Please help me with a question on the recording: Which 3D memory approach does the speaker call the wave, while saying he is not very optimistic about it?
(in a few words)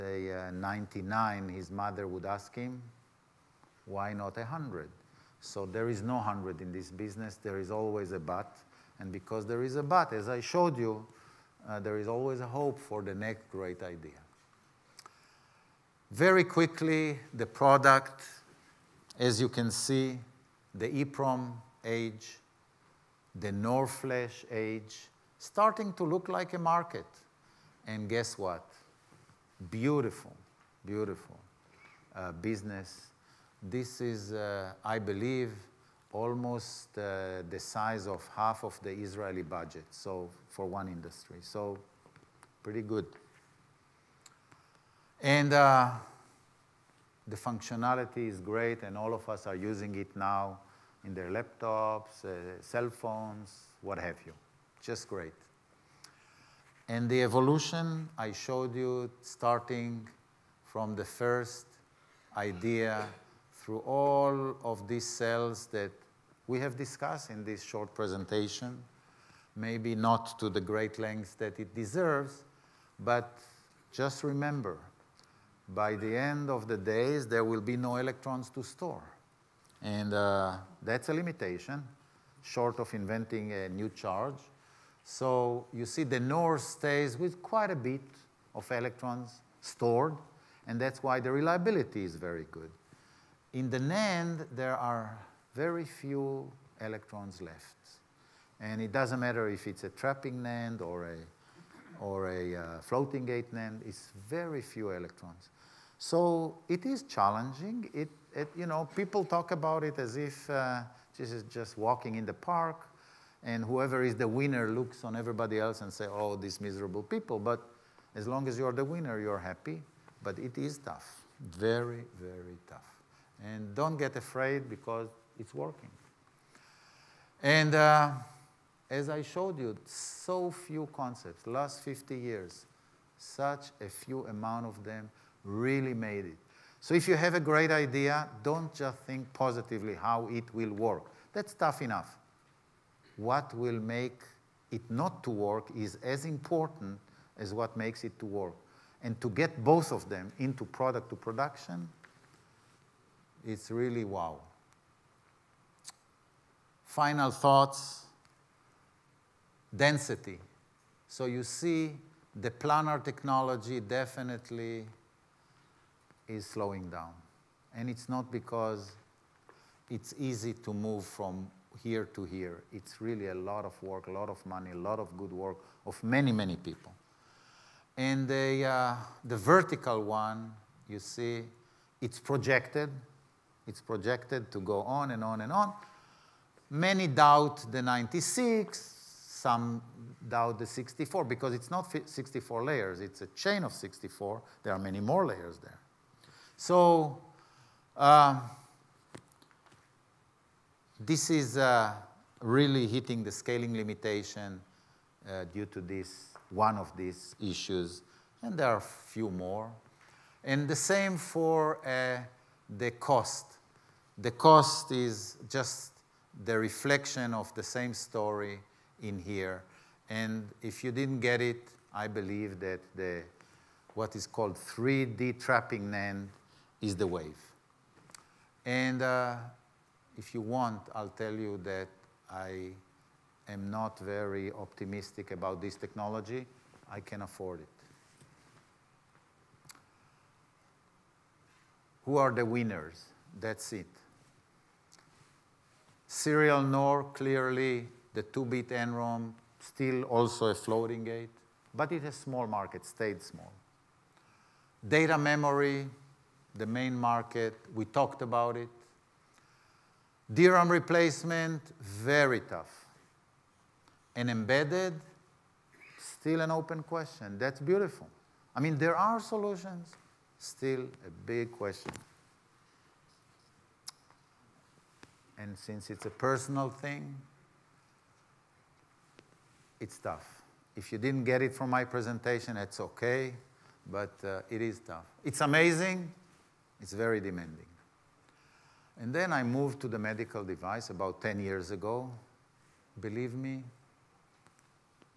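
3D trapping NAND.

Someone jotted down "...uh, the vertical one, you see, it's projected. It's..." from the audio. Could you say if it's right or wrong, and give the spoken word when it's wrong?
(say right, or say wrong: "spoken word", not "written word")
right.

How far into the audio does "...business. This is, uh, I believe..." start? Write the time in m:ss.
0:32.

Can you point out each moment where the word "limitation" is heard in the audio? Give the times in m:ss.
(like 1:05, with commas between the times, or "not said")
1:21, 3:23.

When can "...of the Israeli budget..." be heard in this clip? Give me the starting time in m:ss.
0:38.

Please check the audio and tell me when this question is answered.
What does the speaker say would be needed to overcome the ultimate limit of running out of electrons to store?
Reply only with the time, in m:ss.
1:23.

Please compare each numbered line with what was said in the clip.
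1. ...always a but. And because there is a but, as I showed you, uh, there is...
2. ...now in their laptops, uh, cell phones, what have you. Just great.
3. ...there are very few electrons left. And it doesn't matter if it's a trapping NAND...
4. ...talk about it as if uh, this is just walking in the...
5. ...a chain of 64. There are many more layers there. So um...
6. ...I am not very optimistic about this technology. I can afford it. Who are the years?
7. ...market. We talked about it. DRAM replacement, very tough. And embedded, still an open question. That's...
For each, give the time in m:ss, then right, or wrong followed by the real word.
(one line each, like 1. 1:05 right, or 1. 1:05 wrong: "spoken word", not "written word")
1. 0:07 right
2. 0:50 right
3. 1:34 right
4. 1:49 right
5. 3:13 right
6. 3:52 wrong: "winners", not "years"
7. 4:16 right.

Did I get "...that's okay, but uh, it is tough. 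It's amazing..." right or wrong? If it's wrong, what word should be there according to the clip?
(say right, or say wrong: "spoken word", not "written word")
right.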